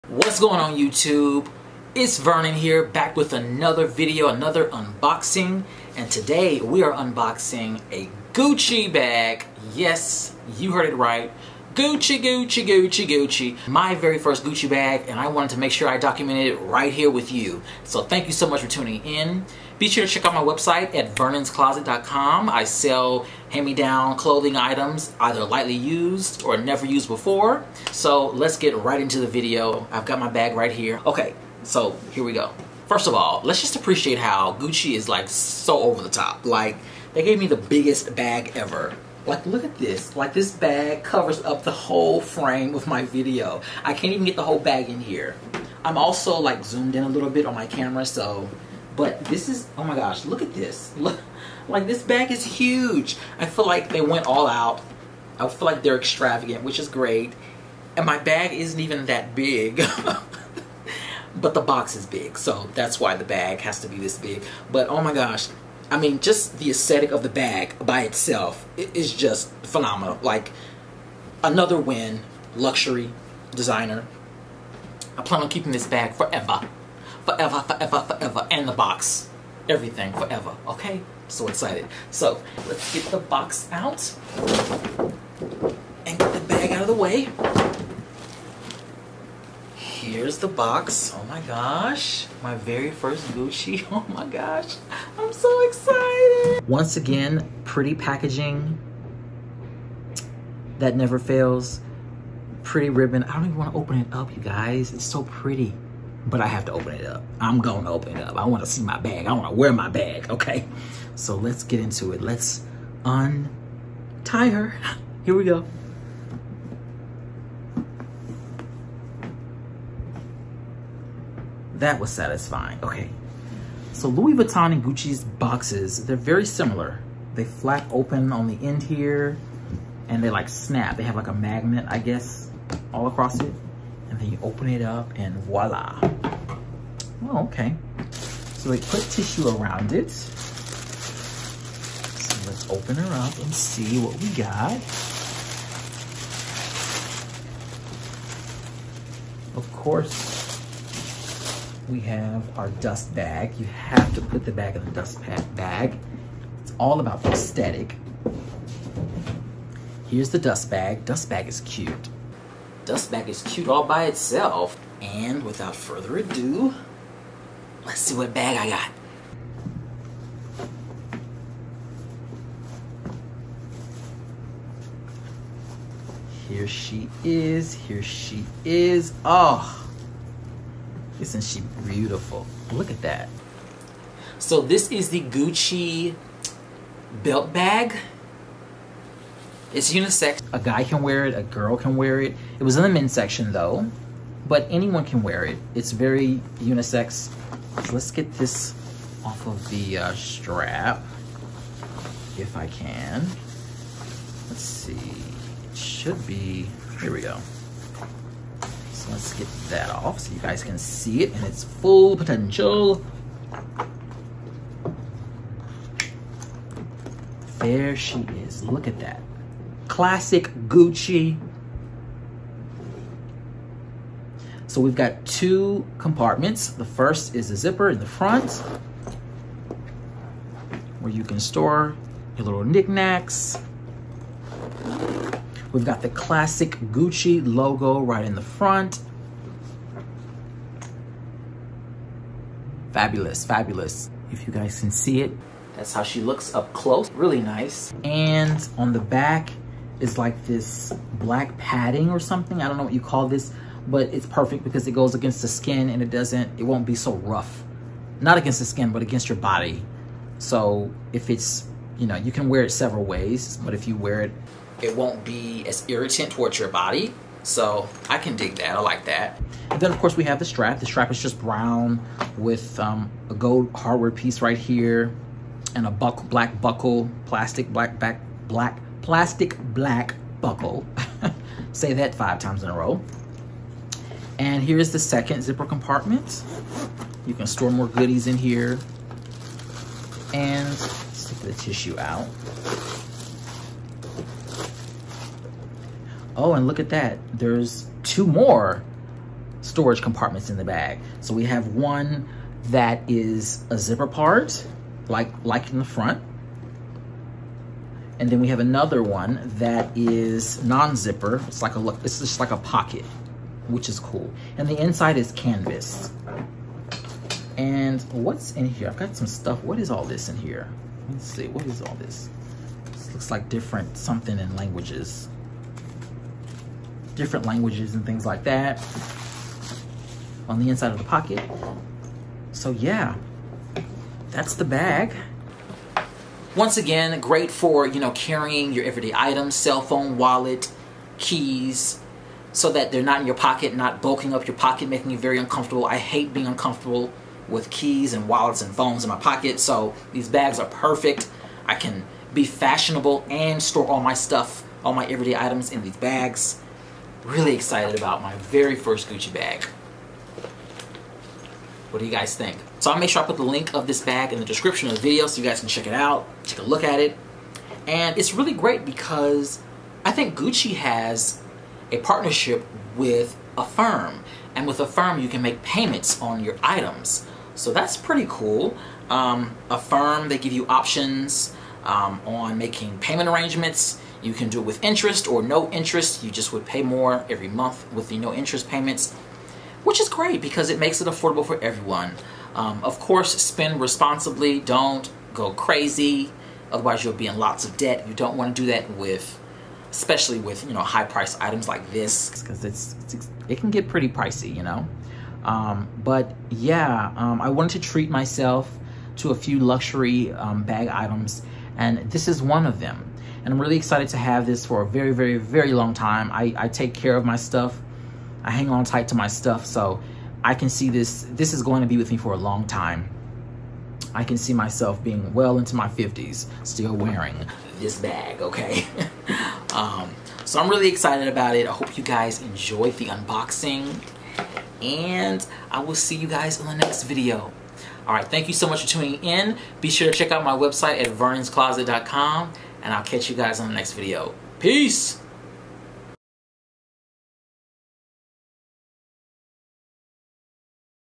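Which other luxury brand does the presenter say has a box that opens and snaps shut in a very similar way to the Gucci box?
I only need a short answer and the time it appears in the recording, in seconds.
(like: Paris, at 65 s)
Louis Vuitton, at 124 s.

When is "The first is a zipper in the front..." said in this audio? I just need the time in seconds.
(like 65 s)
226 s.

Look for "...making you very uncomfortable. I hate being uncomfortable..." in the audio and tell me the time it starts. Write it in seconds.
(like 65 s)
344 s.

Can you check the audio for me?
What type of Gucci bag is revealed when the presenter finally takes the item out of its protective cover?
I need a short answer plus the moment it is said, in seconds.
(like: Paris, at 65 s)
Belt bag, at 185 s.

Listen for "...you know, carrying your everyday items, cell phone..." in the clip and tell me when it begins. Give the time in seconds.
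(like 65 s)
337 s.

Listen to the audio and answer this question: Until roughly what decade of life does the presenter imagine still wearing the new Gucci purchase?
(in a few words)
50s.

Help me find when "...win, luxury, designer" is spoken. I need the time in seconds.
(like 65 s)
71 s.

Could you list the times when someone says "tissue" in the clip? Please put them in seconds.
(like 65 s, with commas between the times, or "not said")
139 s, 291 s.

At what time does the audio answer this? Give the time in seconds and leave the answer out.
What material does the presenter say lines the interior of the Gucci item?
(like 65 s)
315 s.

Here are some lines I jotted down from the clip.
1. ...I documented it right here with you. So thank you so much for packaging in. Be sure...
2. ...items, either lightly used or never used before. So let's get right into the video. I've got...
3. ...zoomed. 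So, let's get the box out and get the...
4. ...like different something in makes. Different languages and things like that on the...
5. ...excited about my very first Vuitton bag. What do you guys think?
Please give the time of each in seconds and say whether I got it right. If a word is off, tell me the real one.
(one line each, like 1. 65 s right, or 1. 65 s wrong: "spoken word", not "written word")
1. 15 s wrong: "tuning", not "packaging"
2. 24 s right
3. 81 s wrong: "excited", not "zoomed"
4. 323 s wrong: "languages", not "makes"
5. 357 s wrong: "Gucci", not "Vuitton".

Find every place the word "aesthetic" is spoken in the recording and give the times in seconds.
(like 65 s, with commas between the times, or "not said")
66 s, 157 s.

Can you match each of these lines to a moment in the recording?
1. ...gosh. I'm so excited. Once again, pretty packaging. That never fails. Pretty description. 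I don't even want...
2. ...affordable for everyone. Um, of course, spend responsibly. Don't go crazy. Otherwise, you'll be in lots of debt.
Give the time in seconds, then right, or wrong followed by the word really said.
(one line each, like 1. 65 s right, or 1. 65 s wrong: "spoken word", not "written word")
1. 94 s wrong: "ribbon", not "description"
2. 391 s right.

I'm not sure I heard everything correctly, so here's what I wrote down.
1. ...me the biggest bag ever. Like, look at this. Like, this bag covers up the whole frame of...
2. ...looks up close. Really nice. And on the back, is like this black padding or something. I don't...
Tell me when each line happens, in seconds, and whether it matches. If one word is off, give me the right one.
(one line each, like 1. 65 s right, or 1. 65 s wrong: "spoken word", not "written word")
1. 37 s right
2. 246 s right.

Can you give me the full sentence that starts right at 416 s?
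I, I take care of my stuff I hang on tight to my stuff.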